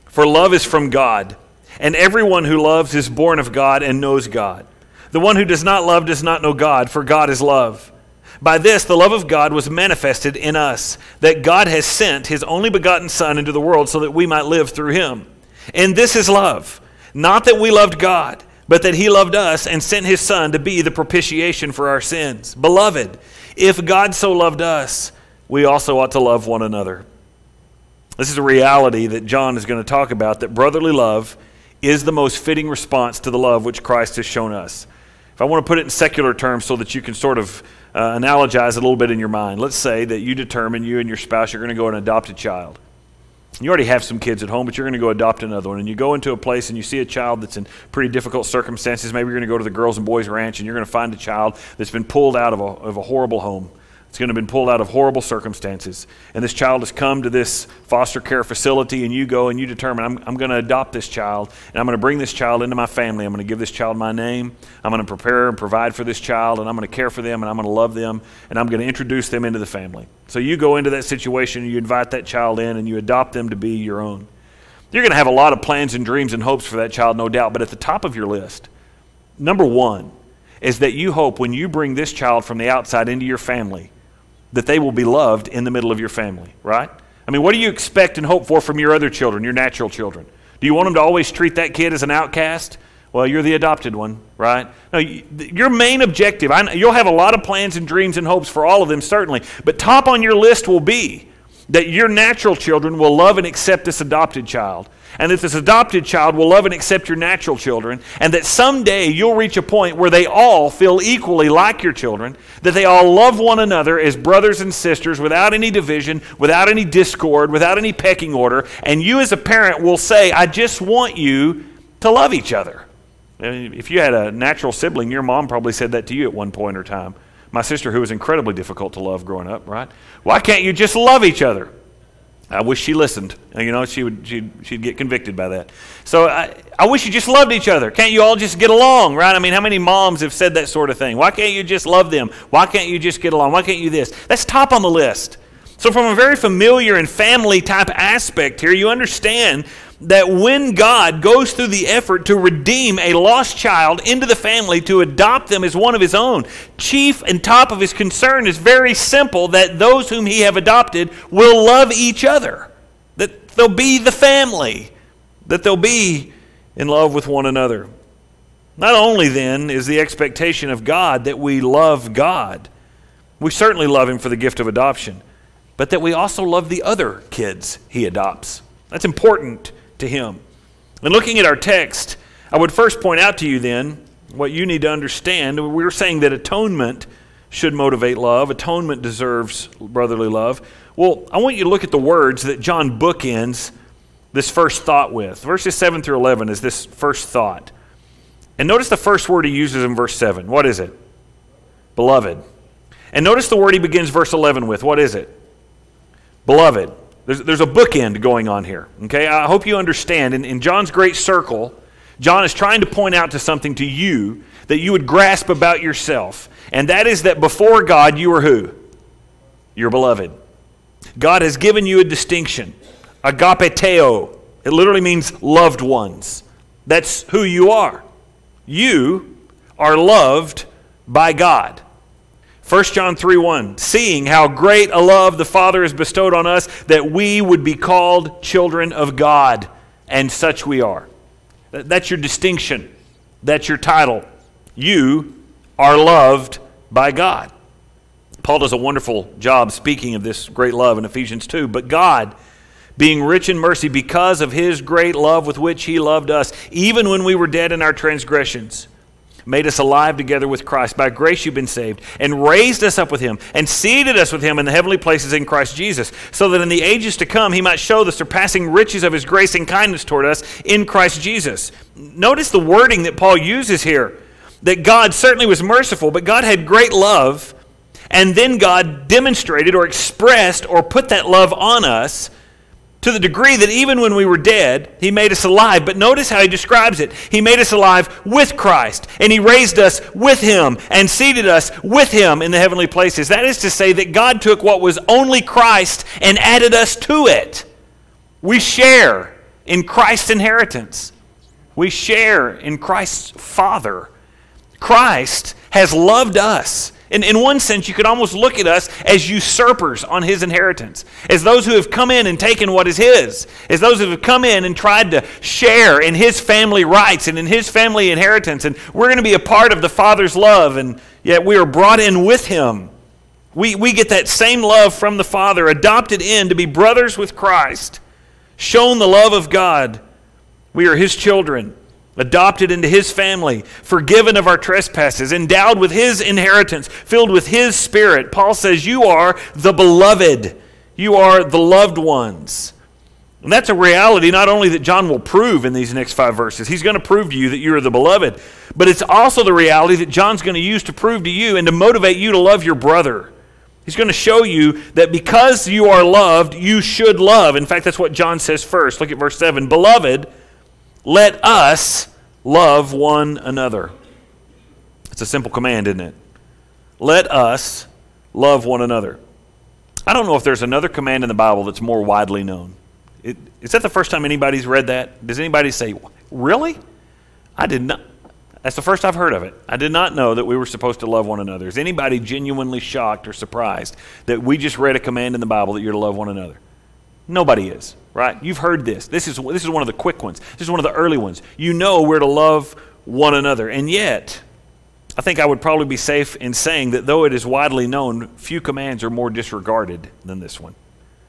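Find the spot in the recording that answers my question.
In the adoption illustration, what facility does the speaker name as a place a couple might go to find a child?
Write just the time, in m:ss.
0:49.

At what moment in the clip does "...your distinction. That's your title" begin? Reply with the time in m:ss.
4:02.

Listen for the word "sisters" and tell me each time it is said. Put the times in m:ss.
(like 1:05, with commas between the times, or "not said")
1:54, 2:07.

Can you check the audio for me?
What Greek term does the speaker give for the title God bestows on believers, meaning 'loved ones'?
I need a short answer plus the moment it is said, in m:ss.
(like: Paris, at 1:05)
agapetoi, at 3:43.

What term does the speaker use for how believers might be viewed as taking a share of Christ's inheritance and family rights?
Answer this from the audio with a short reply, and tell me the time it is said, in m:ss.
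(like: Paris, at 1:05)
usurpers, at 5:09.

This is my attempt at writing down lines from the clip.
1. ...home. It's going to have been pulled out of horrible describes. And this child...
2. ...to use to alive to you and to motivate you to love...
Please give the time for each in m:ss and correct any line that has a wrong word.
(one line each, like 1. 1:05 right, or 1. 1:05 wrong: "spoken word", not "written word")
1. 0:53 wrong: "circumstances", not "describes"
2. 5:50 wrong: "prove", not "alive".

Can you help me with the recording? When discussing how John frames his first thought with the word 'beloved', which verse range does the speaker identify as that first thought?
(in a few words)
Verses 7 through 11.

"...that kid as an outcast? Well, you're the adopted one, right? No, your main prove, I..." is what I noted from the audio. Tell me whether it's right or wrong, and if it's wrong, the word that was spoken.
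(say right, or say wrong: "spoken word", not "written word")
wrong: "objective", not "prove".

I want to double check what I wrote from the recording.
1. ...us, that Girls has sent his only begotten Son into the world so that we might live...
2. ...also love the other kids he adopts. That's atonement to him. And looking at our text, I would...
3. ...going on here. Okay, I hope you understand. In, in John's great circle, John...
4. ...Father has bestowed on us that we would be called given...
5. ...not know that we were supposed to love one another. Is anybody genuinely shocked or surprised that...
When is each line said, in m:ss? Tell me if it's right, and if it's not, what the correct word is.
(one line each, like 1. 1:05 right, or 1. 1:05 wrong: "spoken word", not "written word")
1. 0:10 wrong: "God", not "Girls"
2. 2:56 wrong: "important", not "atonement"
3. 3:28 right
4. 3:55 wrong: "children", not "given"
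5. 6:19 right.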